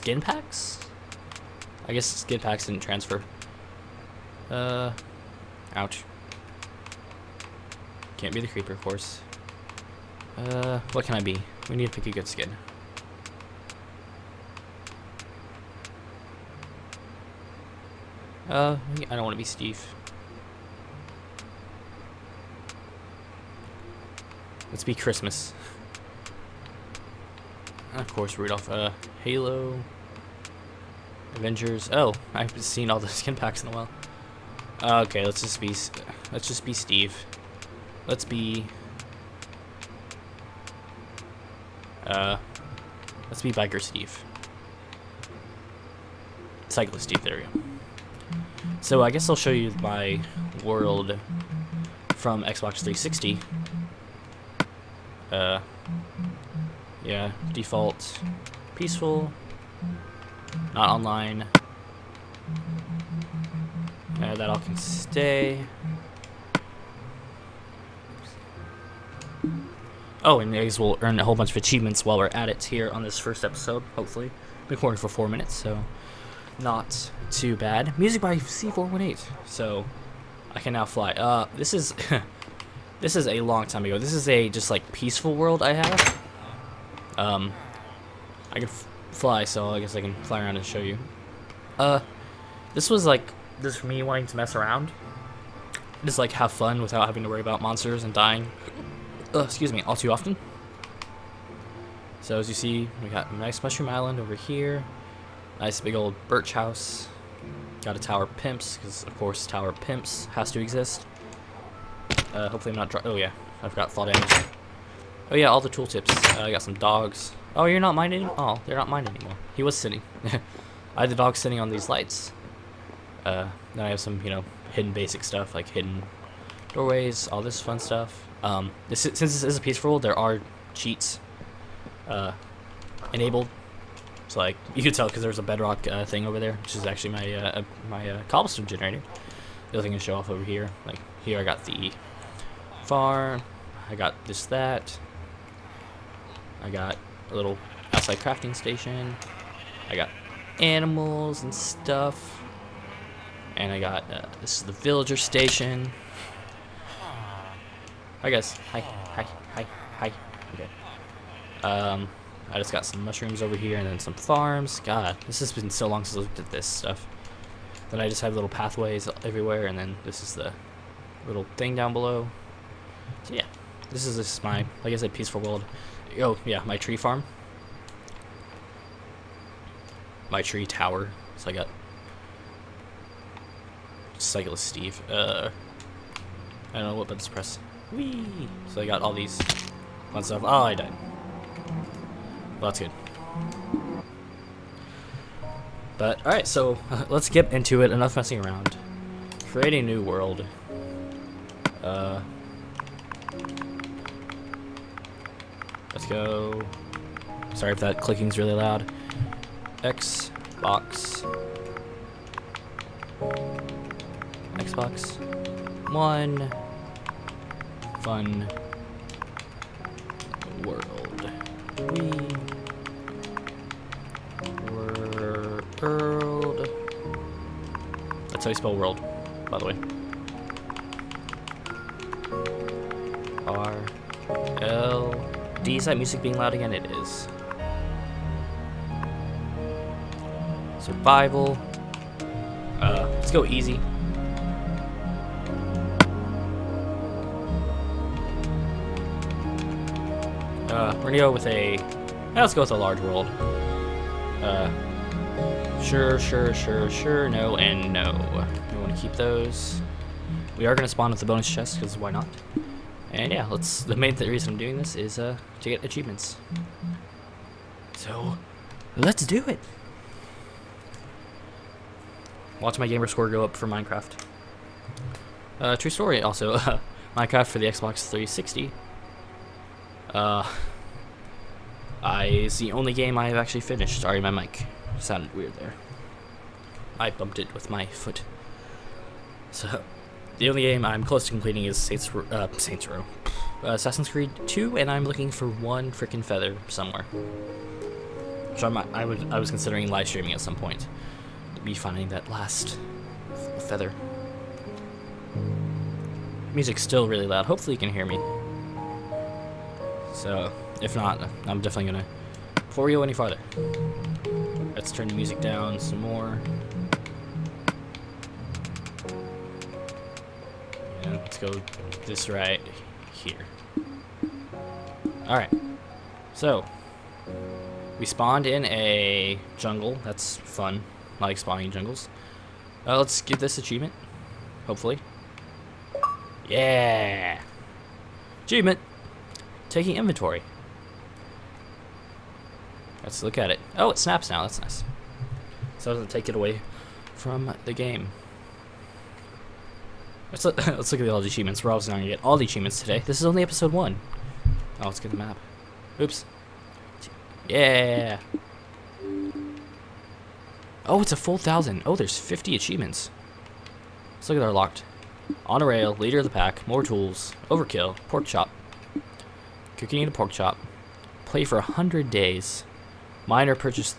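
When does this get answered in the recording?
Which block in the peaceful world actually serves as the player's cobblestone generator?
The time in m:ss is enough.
2:15.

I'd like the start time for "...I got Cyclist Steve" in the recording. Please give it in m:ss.
3:01.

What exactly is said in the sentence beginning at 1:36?
Just like have fun without having to worry about monsters and dying.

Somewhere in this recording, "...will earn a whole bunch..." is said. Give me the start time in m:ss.
1:10.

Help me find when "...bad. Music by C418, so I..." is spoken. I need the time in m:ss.
1:17.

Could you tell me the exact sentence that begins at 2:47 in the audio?
Then I just have little pathways everywhere and then this is the little thing down below.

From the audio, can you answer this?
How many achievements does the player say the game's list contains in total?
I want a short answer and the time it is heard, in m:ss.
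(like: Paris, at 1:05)
50, at 6:02.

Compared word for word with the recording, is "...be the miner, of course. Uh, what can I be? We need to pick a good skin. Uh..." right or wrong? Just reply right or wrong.
wrong.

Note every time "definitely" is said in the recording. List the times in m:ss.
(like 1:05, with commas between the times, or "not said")
5:11.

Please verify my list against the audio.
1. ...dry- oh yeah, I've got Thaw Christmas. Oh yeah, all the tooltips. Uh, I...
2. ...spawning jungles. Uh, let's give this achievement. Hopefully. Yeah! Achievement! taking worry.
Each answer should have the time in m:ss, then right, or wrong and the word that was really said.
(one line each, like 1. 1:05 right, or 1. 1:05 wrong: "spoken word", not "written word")
1. 1:52 wrong: "Damage", not "Christmas"
2. 5:31 wrong: "inventory", not "worry".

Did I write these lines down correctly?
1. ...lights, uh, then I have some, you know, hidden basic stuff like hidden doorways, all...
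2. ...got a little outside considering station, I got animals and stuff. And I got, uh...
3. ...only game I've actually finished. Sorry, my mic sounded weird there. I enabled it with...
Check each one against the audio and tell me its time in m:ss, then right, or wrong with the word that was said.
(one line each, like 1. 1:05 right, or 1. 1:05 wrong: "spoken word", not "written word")
1. 2:01 right
2. 2:26 wrong: "crafting", not "considering"
3. 4:42 wrong: "bumped", not "enabled".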